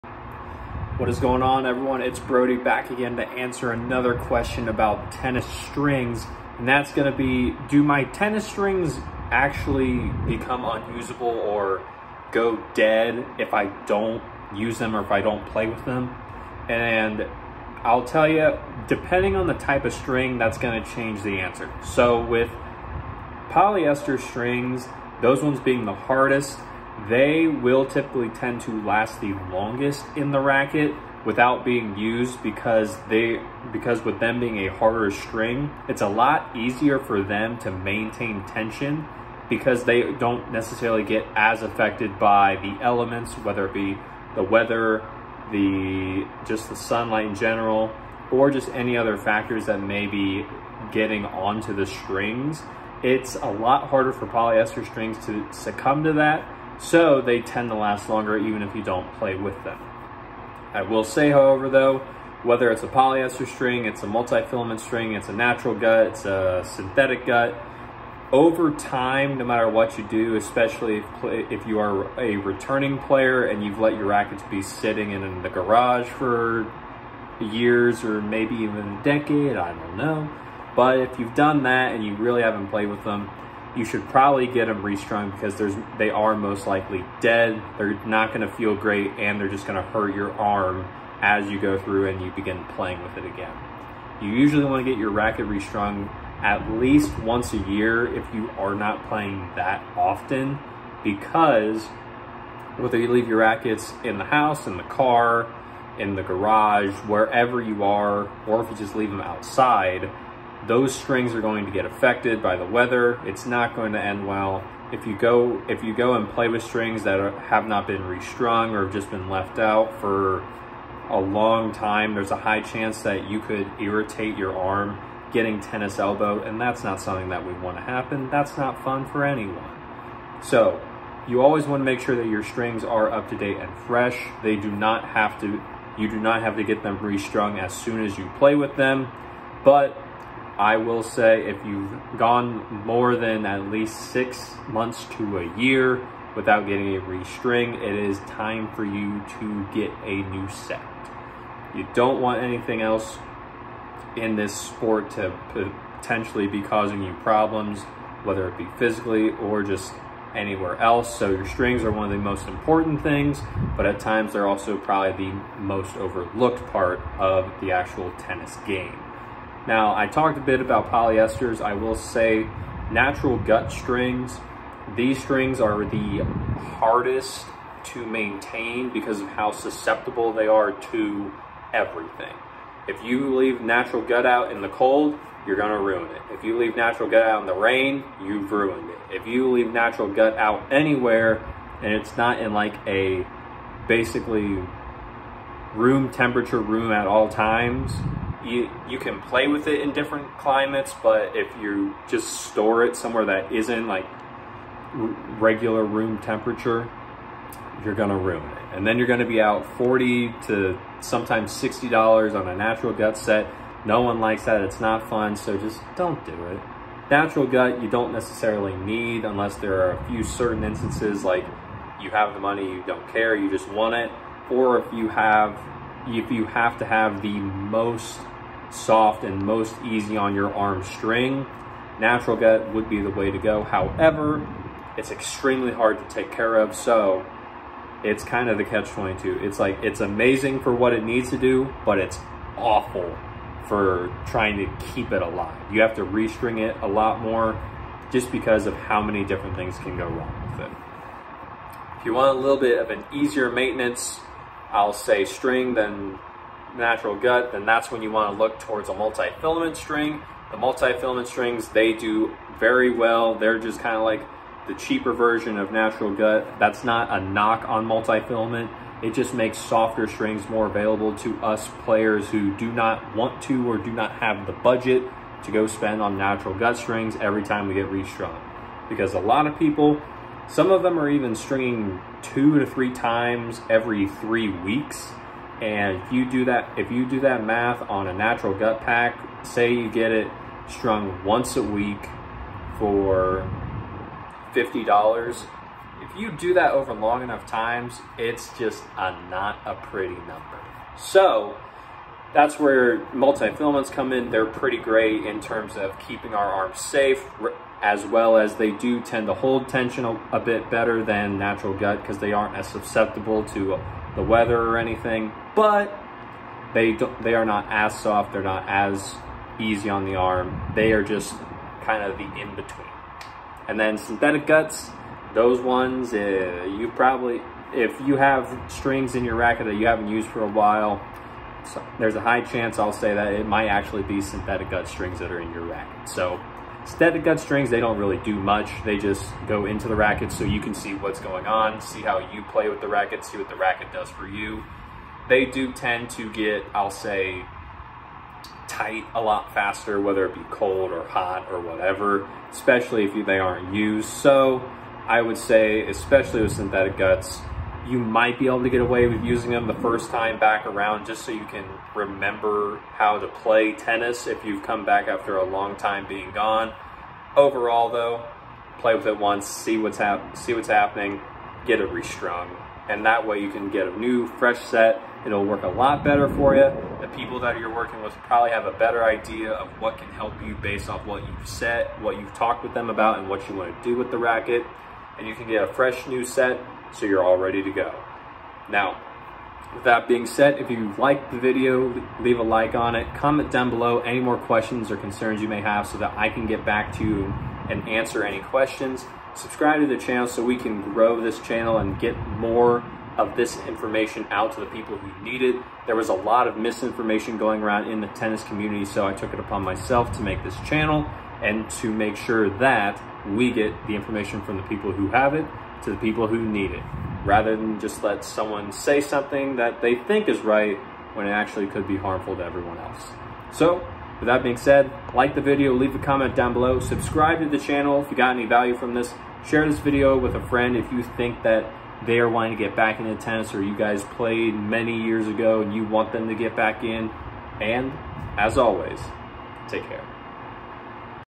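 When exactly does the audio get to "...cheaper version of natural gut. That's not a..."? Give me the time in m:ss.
4:24.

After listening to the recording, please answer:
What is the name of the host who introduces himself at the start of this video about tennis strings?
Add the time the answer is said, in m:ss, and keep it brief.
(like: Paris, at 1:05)
Brody, at 0:02.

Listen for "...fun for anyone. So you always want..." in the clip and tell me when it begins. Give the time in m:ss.
2:08.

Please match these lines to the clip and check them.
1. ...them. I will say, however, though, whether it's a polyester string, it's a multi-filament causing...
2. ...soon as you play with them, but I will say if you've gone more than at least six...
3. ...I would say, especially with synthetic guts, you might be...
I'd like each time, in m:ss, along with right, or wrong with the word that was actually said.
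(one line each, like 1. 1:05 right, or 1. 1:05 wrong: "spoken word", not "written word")
1. 0:59 wrong: "string", not "causing"
2. 2:17 right
3. 5:55 right.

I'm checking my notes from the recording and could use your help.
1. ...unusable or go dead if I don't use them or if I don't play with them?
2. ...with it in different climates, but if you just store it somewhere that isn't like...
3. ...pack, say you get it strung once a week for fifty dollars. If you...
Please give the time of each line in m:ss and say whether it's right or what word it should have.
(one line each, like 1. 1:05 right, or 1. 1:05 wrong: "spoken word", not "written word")
1. 0:10 right
2. 3:19 right
3. 4:48 right.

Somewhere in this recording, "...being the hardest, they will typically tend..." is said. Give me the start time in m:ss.
0:25.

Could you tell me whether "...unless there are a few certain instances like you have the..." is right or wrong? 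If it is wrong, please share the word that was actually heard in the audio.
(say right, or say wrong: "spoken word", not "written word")
right.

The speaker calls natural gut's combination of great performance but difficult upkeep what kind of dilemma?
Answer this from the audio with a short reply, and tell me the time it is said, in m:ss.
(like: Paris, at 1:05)
Catch-22, at 3:58.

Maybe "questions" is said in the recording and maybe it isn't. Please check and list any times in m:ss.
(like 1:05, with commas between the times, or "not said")
0:04, 6:34, 6:38.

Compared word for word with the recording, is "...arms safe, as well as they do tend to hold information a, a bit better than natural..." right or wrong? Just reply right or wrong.
wrong.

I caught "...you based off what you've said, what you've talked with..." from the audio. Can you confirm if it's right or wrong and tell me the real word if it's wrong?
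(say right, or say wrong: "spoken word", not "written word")
right.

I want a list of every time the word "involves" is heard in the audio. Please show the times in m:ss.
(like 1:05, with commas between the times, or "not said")
not said.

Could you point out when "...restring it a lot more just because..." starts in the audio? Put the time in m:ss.
4:06.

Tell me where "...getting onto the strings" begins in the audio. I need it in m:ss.
0:50.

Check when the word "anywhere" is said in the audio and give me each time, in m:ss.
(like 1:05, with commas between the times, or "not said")
2:40, 3:10.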